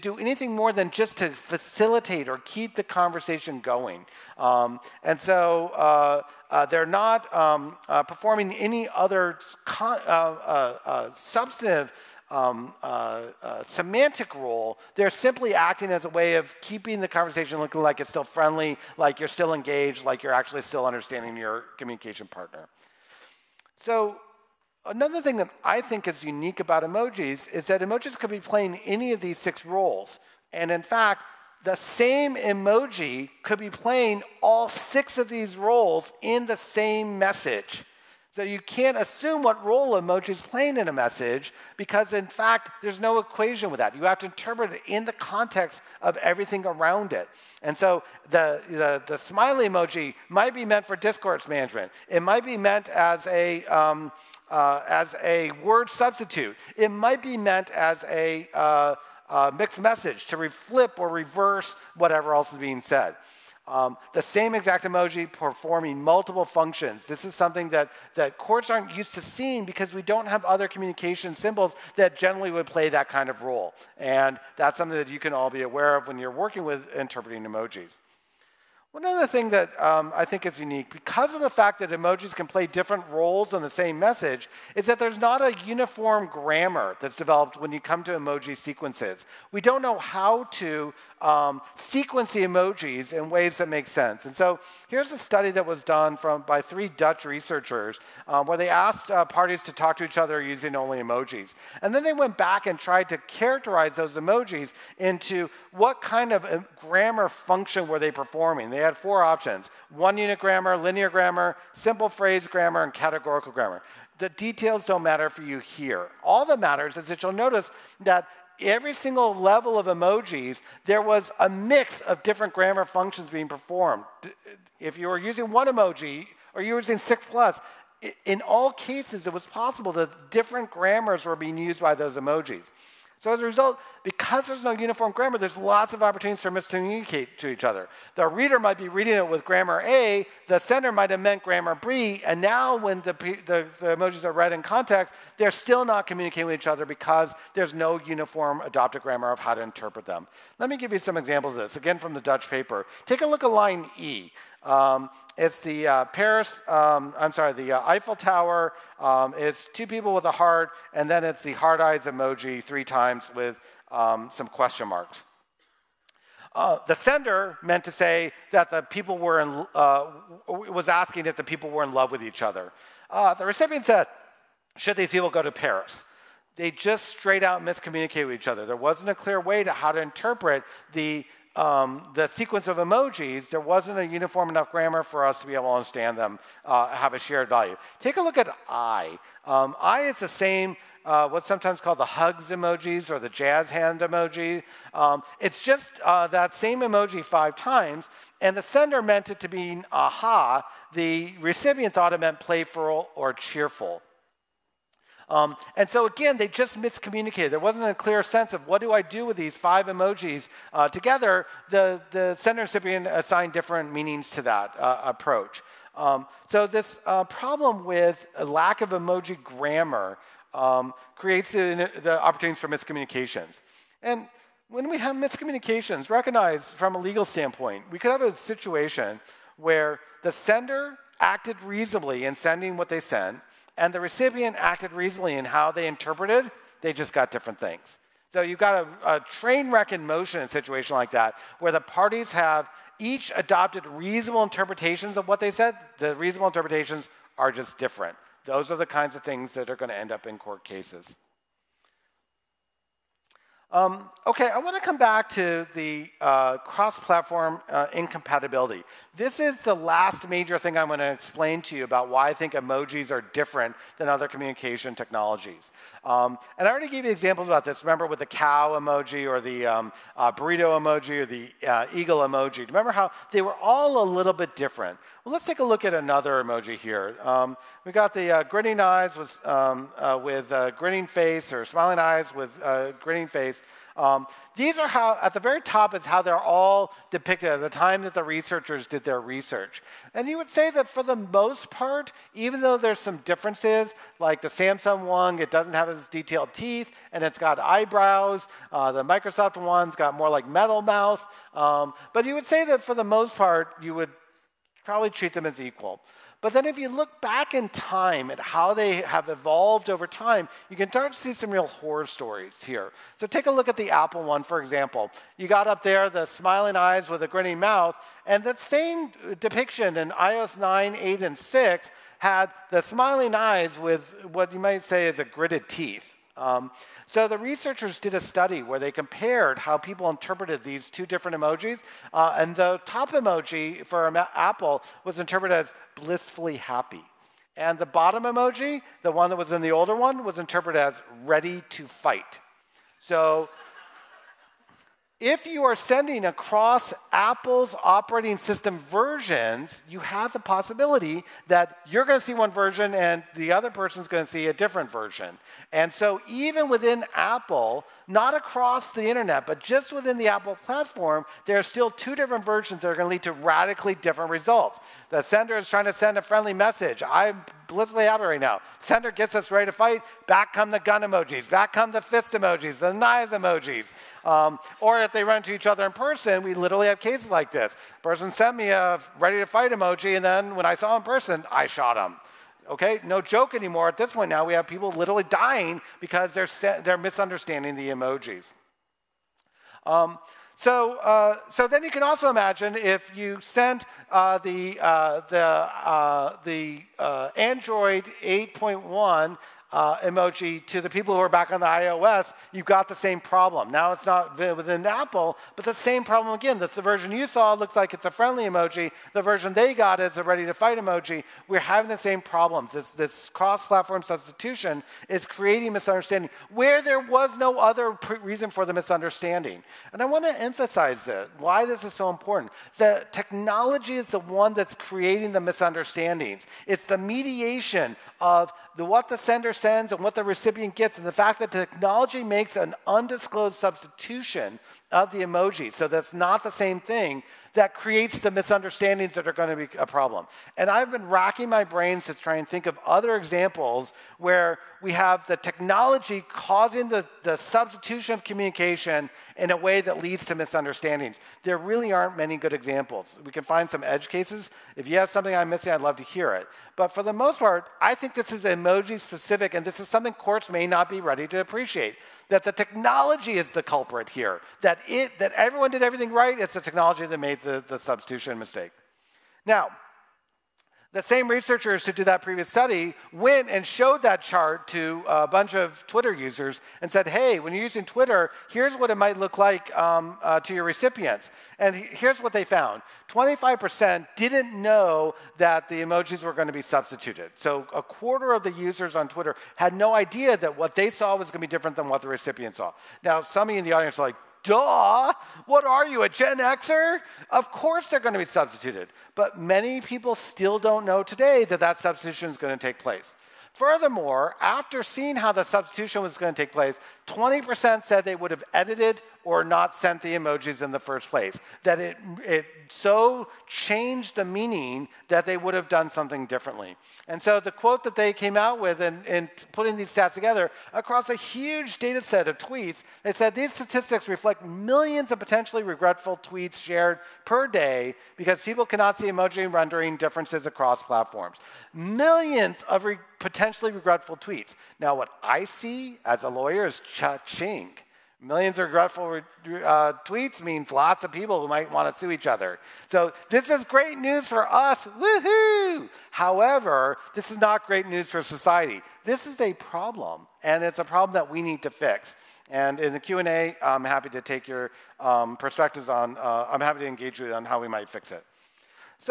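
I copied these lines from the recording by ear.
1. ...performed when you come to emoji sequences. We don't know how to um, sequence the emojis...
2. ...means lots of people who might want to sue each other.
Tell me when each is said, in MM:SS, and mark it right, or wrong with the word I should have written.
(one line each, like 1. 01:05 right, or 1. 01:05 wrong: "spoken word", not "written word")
1. 01:27 wrong: "developed", not "performed"
2. 09:00 right.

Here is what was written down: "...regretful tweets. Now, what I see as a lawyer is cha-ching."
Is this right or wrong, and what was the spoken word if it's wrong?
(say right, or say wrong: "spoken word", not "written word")
right.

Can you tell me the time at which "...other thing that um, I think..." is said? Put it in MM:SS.
01:19.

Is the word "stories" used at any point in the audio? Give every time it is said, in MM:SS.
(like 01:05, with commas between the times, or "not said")
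05:12.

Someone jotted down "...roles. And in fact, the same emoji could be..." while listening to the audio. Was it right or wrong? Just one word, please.
right.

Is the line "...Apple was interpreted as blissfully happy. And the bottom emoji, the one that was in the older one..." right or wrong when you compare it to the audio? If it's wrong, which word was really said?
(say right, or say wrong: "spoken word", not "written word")
right.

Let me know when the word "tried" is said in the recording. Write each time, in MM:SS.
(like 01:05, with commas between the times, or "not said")
01:42.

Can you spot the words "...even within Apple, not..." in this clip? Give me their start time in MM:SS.
05:56.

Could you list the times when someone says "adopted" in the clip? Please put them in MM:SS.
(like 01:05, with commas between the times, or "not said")
02:28, 04:03.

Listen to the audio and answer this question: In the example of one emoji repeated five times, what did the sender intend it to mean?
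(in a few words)
aha.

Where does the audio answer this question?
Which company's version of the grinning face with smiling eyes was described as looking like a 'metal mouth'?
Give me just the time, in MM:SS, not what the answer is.
04:59.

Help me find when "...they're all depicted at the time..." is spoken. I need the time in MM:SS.
04:46.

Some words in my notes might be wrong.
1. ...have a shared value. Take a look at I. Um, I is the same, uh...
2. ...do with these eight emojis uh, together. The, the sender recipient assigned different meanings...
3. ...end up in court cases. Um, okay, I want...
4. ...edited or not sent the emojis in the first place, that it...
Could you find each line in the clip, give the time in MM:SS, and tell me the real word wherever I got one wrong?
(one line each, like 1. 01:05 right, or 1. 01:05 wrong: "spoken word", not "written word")
1. 03:06 right
2. 03:29 wrong: "five", not "eight"
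3. 04:09 right
4. 08:28 right.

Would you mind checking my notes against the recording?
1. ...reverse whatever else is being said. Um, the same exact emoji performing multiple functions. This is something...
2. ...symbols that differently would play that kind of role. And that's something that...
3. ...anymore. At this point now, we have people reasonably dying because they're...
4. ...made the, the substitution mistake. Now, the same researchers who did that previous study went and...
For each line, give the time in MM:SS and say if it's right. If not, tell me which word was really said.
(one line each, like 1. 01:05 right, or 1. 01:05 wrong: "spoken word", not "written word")
1. 01:01 right
2. 01:11 wrong: "generally", not "differently"
3. 06:23 wrong: "literally", not "reasonably"
4. 07:47 right.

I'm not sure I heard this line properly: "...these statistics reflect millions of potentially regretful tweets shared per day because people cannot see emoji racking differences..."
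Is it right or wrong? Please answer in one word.
wrong.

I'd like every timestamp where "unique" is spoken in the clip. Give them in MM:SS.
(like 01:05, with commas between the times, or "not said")
00:26, 01:20.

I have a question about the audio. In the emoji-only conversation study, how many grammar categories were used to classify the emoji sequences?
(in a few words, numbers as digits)
4.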